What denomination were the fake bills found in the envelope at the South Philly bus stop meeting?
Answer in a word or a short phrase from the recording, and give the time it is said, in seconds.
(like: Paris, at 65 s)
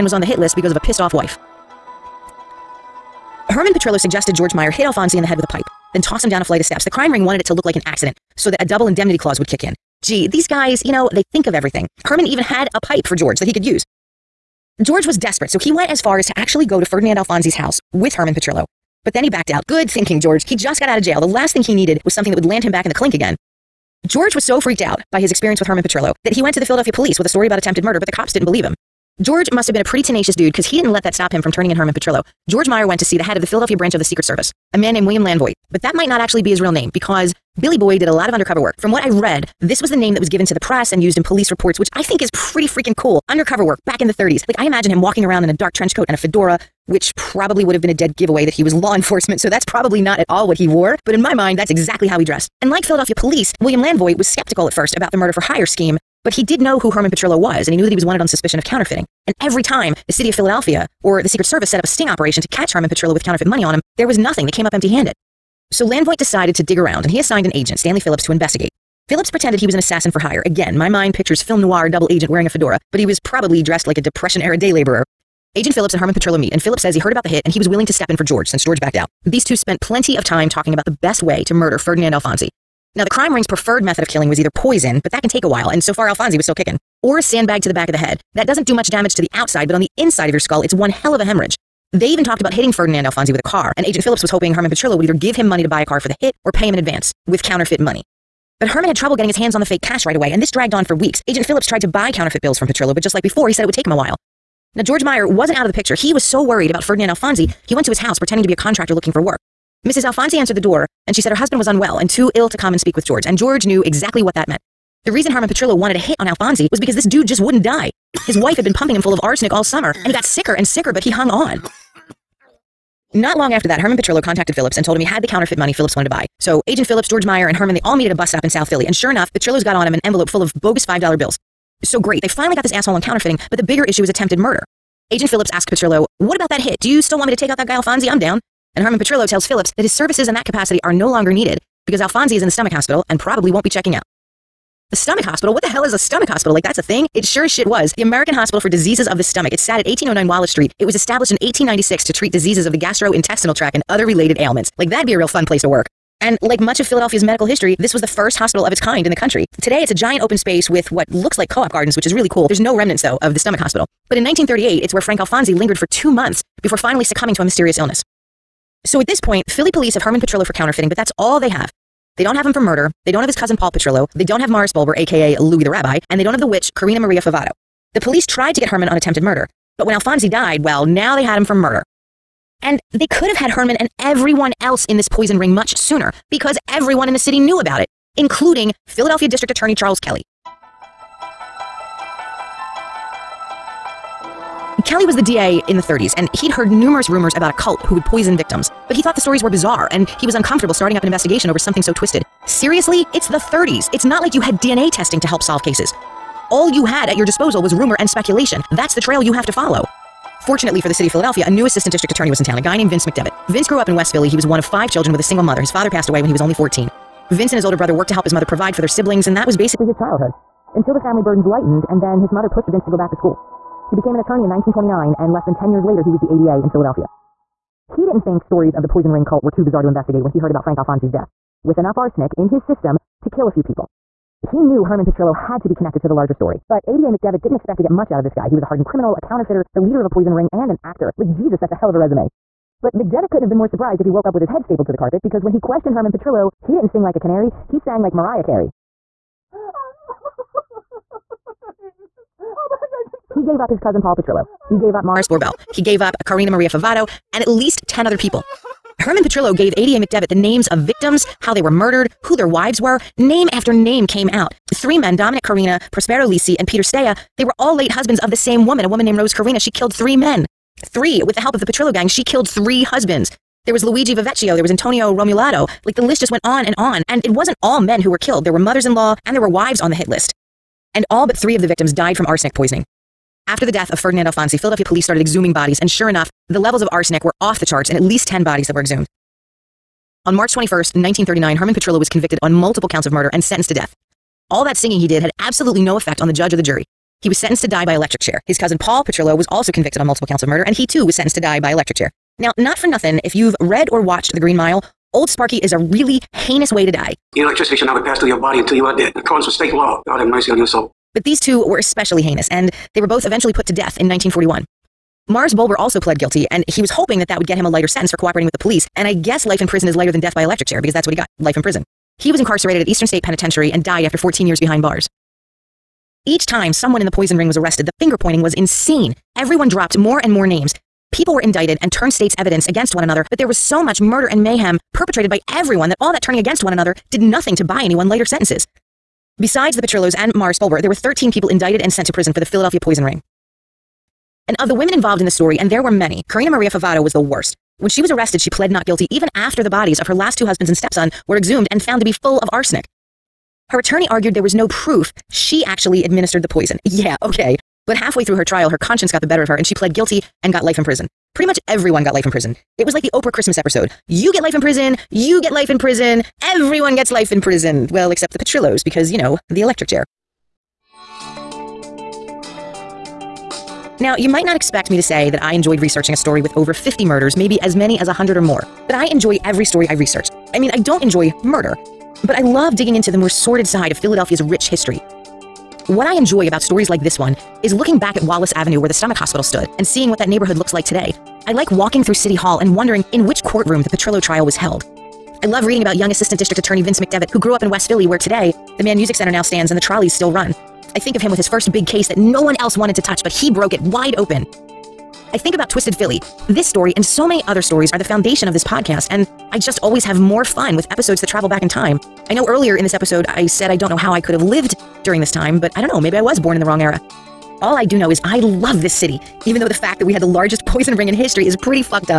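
$5, at 130 s.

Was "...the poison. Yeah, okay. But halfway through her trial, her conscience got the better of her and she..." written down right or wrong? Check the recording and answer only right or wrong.
right.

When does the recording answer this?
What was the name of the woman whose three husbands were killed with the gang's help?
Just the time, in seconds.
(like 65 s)
269 s.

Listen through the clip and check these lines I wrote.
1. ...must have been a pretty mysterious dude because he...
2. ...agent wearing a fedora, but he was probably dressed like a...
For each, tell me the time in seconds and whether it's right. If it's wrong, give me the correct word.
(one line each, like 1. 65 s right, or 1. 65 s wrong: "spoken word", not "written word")
1. 29 s wrong: "tenacious", not "mysterious"
2. 72 s right.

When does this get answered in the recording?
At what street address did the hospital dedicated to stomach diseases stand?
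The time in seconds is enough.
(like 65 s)
149 s.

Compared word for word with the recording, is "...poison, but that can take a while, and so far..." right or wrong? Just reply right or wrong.
right.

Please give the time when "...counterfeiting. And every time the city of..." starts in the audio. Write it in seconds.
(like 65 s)
58 s.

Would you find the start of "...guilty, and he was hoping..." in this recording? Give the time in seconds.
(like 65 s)
316 s.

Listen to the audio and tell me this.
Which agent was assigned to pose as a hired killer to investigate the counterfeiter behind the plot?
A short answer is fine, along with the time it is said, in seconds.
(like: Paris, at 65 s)
Stanley Phillips, at 67 s.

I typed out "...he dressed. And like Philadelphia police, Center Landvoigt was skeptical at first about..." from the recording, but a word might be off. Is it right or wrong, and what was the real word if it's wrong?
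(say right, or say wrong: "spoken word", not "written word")
wrong: "William", not "Center".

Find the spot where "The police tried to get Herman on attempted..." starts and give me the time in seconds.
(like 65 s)
177 s.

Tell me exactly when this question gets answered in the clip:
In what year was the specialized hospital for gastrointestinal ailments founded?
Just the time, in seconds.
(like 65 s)
151 s.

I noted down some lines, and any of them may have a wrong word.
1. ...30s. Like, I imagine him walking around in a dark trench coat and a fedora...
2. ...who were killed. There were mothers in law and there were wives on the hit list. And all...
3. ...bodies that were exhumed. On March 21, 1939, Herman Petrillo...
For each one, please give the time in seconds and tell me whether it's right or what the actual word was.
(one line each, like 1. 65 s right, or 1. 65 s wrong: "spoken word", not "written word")
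1. 44 s right
2. 278 s right
3. 288 s right.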